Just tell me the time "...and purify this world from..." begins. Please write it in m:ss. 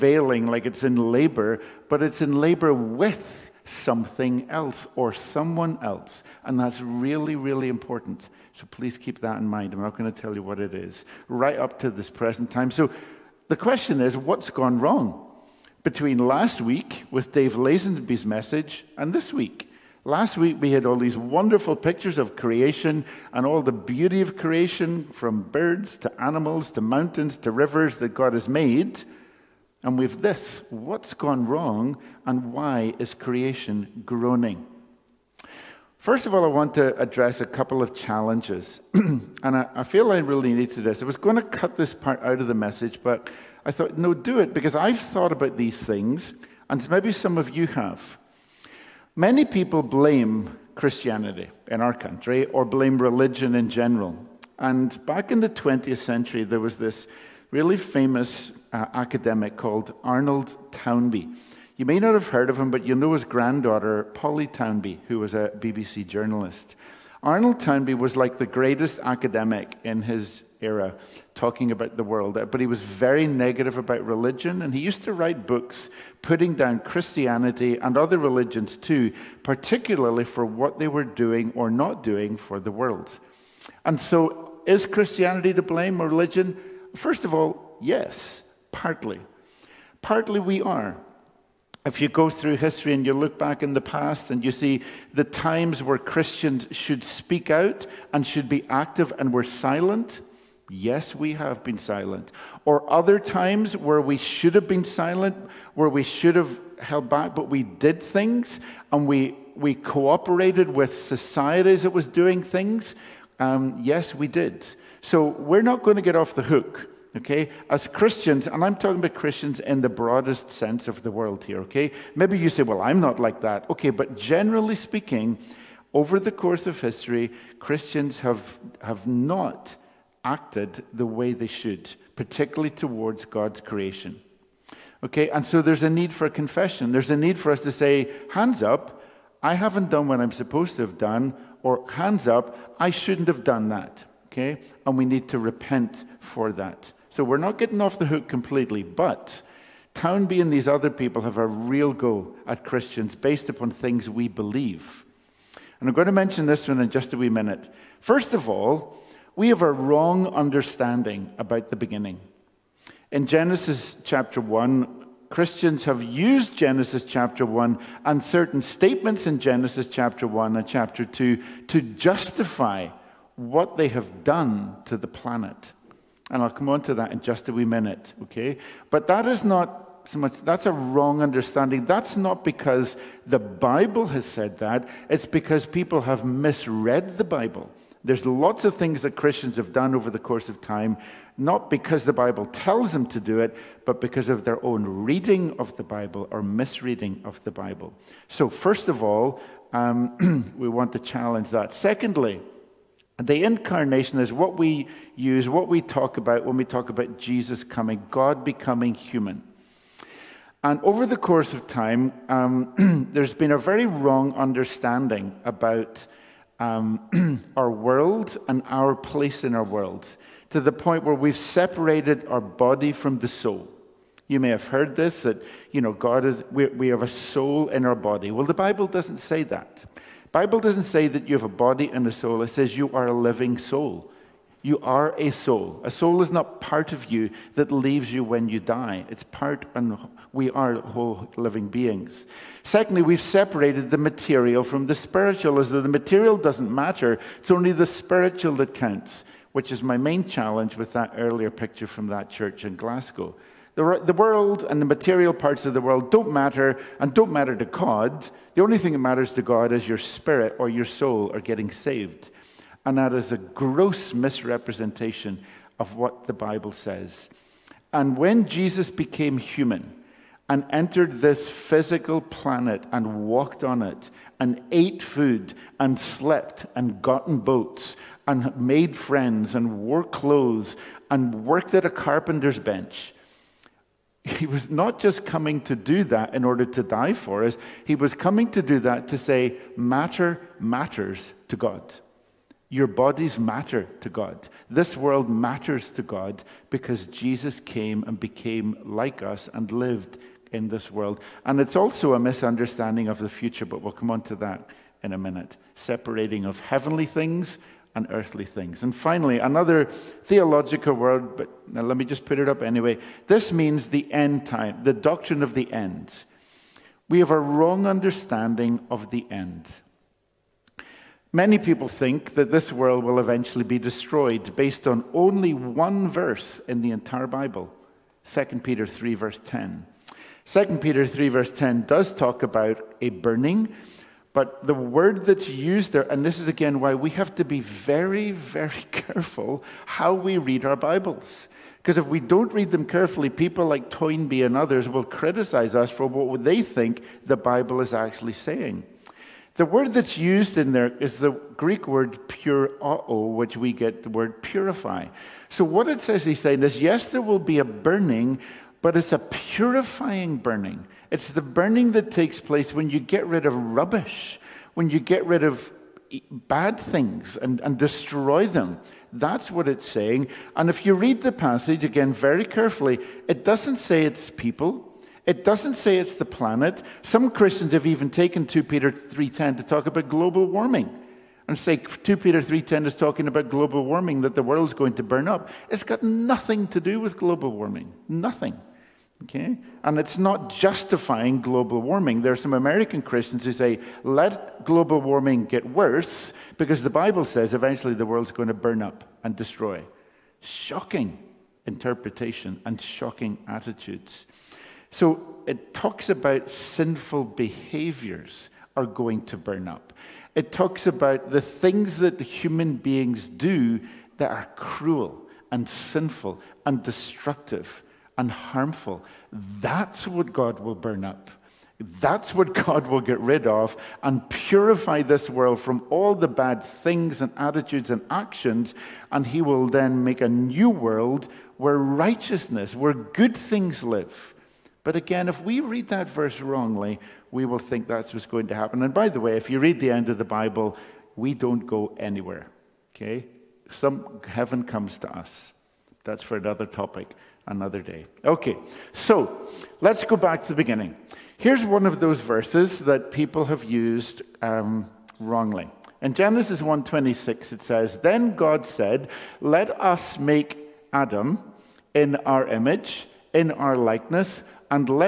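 7:04.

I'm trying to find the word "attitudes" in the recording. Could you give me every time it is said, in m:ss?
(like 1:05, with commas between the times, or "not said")
6:43, 7:07.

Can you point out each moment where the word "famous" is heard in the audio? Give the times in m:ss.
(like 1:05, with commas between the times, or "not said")
0:57.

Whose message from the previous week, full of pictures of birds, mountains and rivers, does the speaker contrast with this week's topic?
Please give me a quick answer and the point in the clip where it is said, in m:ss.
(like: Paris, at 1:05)
Dave Lazenby, at 0:17.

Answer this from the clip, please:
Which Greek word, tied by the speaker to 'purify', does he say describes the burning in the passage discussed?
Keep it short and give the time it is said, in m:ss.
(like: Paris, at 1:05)
purao, at 5:52.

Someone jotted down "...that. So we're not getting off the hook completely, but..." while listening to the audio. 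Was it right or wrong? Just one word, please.
right.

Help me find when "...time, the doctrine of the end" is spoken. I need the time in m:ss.
5:14.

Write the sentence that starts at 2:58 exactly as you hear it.
But that is not so much, that's a wrong understanding.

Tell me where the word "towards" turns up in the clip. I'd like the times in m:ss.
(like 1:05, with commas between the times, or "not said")
2:12.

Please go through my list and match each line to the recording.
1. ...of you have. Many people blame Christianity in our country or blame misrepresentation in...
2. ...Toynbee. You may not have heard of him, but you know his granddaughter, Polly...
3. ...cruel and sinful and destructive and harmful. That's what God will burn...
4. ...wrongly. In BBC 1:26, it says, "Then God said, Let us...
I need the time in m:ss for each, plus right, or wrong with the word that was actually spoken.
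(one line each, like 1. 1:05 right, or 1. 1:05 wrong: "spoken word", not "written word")
1. 0:47 wrong: "religion", not "misrepresentation"
2. 1:00 right
3. 6:54 right
4. 7:35 wrong: "Genesis", not "BBC".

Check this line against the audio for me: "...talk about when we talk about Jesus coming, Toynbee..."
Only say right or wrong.
wrong.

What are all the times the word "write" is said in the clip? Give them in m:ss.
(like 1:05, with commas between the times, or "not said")
1:15.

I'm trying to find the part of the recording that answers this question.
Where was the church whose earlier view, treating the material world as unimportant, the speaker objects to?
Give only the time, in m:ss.
4:12.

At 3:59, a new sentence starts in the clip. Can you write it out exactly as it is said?
It's part, and we are whole living beings.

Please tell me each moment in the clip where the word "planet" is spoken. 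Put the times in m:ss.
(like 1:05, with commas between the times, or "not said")
2:55, 4:32, 6:16.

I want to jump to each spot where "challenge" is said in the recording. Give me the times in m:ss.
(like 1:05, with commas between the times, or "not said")
0:37, 3:20, 4:10.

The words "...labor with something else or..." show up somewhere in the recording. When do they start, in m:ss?
0:02.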